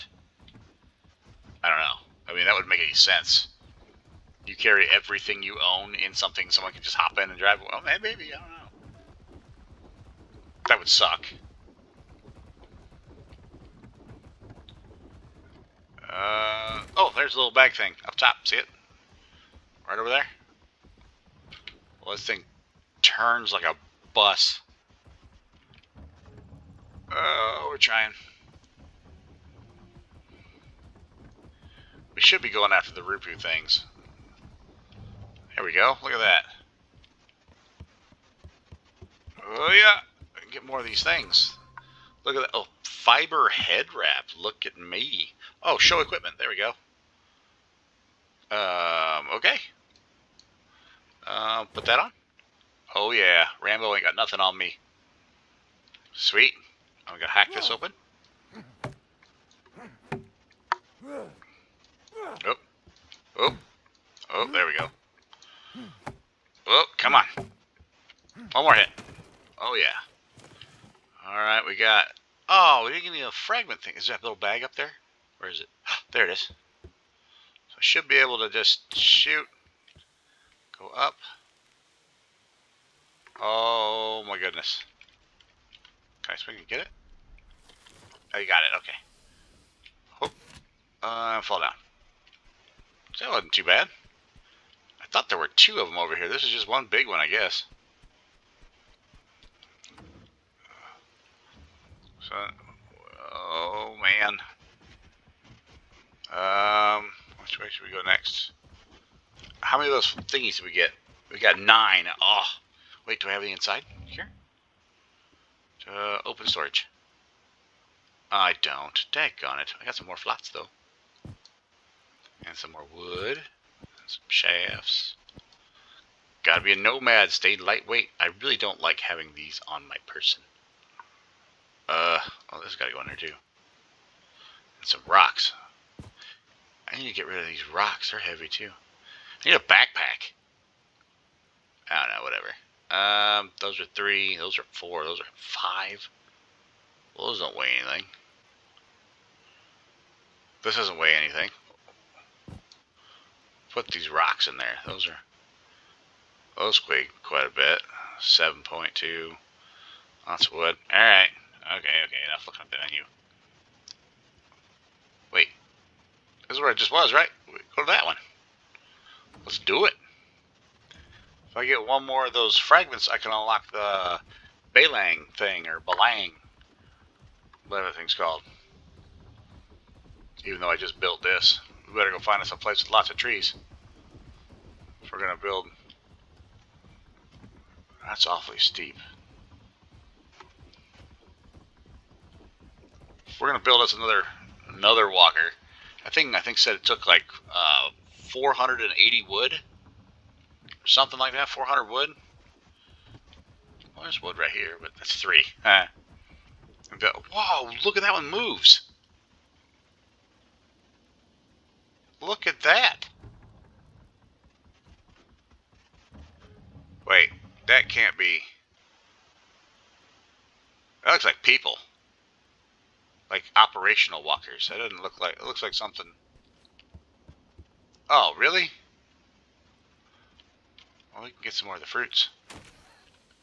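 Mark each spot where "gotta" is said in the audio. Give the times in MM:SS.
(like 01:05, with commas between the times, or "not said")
02:06, 02:12.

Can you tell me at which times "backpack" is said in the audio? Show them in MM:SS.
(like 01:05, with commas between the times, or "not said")
02:19.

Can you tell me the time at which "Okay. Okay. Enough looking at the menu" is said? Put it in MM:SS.
02:41.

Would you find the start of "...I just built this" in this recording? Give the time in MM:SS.
03:00.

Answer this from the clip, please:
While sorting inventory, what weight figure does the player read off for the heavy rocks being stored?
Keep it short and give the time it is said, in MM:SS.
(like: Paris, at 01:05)
7.2, at 02:38.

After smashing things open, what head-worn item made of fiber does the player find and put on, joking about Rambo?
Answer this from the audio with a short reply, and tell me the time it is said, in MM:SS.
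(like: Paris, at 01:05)
Fiber head wrap, at 00:42.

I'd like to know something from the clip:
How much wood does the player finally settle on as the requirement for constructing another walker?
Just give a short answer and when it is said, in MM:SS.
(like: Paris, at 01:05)
400, at 03:21.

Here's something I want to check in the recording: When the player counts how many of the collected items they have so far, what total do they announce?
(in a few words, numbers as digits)
9.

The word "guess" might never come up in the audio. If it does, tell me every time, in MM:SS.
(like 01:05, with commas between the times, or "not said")
01:37.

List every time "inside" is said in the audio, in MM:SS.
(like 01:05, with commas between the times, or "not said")
01:53.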